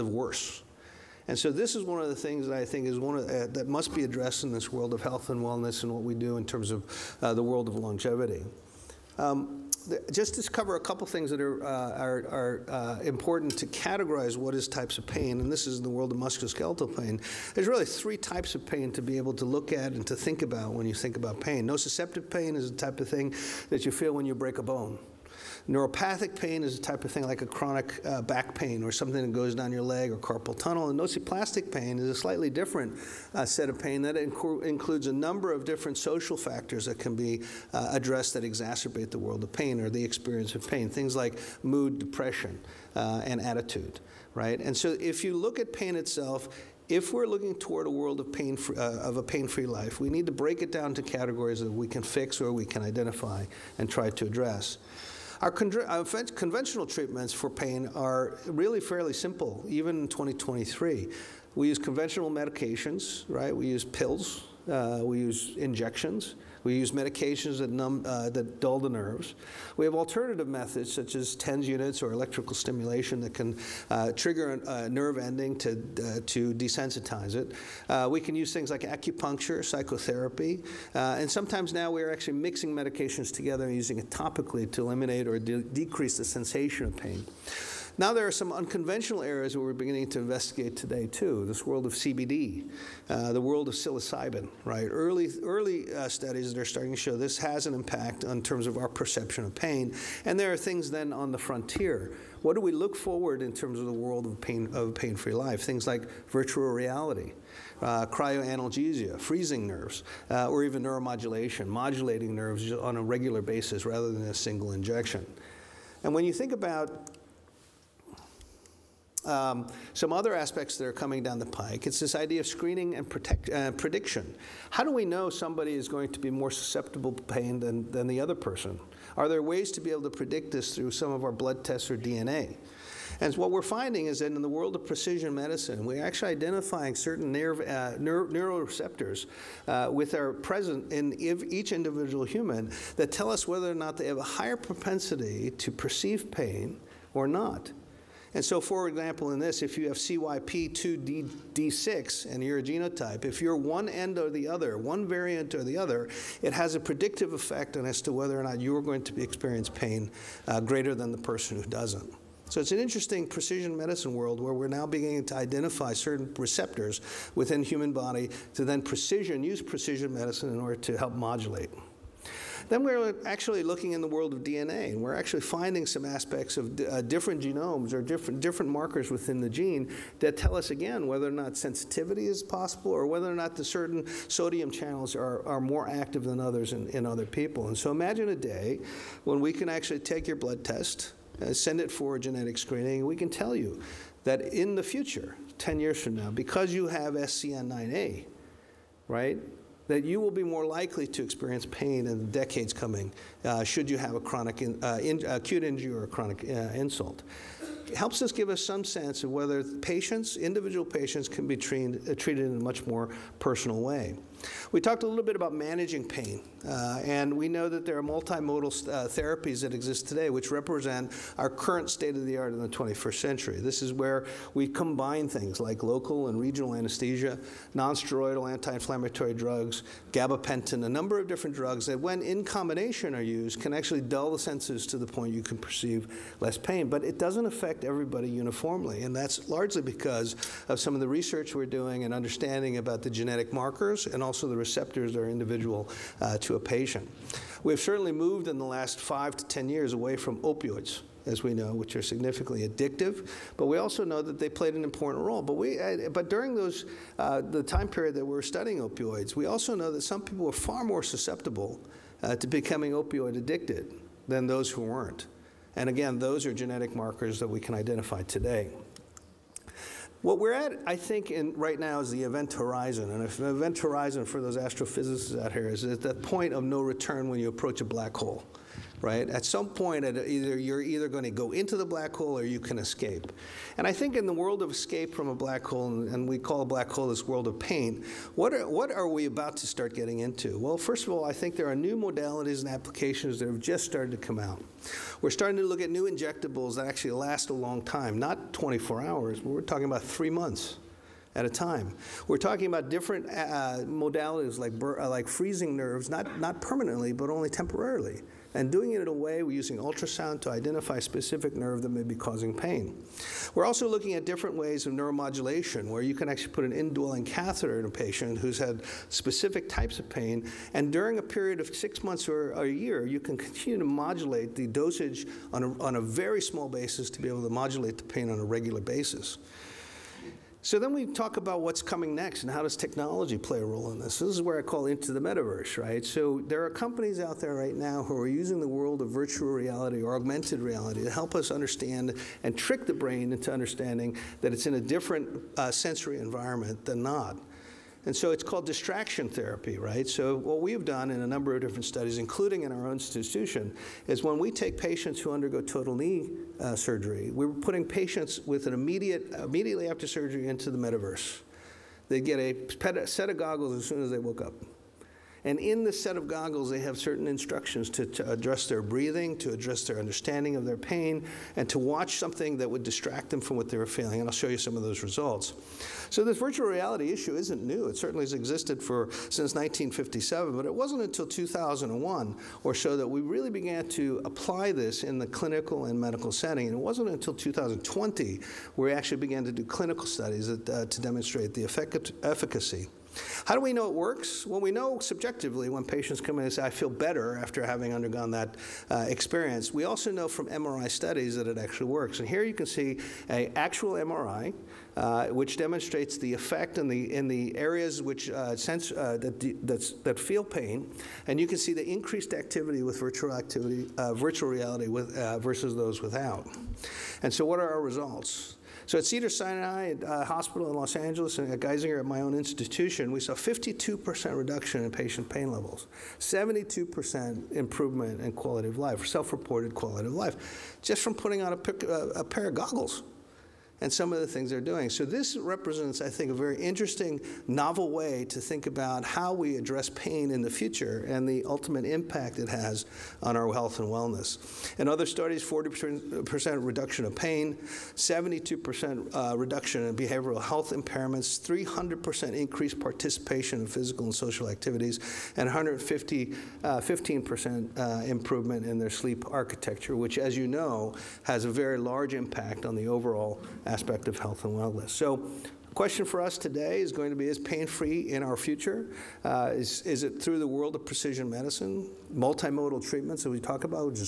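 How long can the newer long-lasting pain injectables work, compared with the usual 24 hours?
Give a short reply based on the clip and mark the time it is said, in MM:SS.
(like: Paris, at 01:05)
3 months, at 05:00.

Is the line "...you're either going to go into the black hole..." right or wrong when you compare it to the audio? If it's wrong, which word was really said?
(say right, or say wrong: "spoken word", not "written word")
right.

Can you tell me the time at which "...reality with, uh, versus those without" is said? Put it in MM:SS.
06:54.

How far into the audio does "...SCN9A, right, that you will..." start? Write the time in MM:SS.
03:17.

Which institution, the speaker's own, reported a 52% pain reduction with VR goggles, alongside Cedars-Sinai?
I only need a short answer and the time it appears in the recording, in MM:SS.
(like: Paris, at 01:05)
Geisinger, at 07:01.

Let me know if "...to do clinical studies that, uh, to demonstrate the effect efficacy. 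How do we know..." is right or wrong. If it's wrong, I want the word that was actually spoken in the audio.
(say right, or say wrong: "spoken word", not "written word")
right.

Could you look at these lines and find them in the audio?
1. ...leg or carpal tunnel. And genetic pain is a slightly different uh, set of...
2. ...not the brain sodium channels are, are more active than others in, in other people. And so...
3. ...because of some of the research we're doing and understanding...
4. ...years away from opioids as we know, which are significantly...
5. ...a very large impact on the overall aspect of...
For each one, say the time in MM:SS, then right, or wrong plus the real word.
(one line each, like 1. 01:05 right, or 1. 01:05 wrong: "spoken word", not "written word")
1. 00:29 wrong: "nociplastic", not "genetic"
2. 03:03 wrong: "certain", not "brain"
3. 03:59 right
4. 04:09 right
5. 07:41 right.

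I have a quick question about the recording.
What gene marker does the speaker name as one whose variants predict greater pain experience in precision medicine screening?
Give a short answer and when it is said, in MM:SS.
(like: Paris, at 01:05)
CYP2D6, at 02:29.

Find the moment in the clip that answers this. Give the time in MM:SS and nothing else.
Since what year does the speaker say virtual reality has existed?
06:19.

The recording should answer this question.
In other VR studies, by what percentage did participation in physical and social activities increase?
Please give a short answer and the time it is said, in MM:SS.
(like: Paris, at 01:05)
300%, at 07:31.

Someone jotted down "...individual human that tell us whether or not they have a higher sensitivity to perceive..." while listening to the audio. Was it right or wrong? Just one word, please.
wrong.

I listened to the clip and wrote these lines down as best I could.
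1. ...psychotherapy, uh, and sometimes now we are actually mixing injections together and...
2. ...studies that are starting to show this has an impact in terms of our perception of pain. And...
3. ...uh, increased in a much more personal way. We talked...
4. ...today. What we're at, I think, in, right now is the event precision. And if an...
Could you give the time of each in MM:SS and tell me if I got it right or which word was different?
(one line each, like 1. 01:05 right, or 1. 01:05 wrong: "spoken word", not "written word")
1. 01:19 wrong: "medications", not "injections"
2. 01:36 right
3. 03:32 wrong: "treated", not "increased"
4. 04:28 wrong: "horizon", not "precision".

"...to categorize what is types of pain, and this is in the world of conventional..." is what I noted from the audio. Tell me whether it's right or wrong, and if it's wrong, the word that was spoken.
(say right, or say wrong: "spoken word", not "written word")
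wrong: "musculoskeletal", not "conventional".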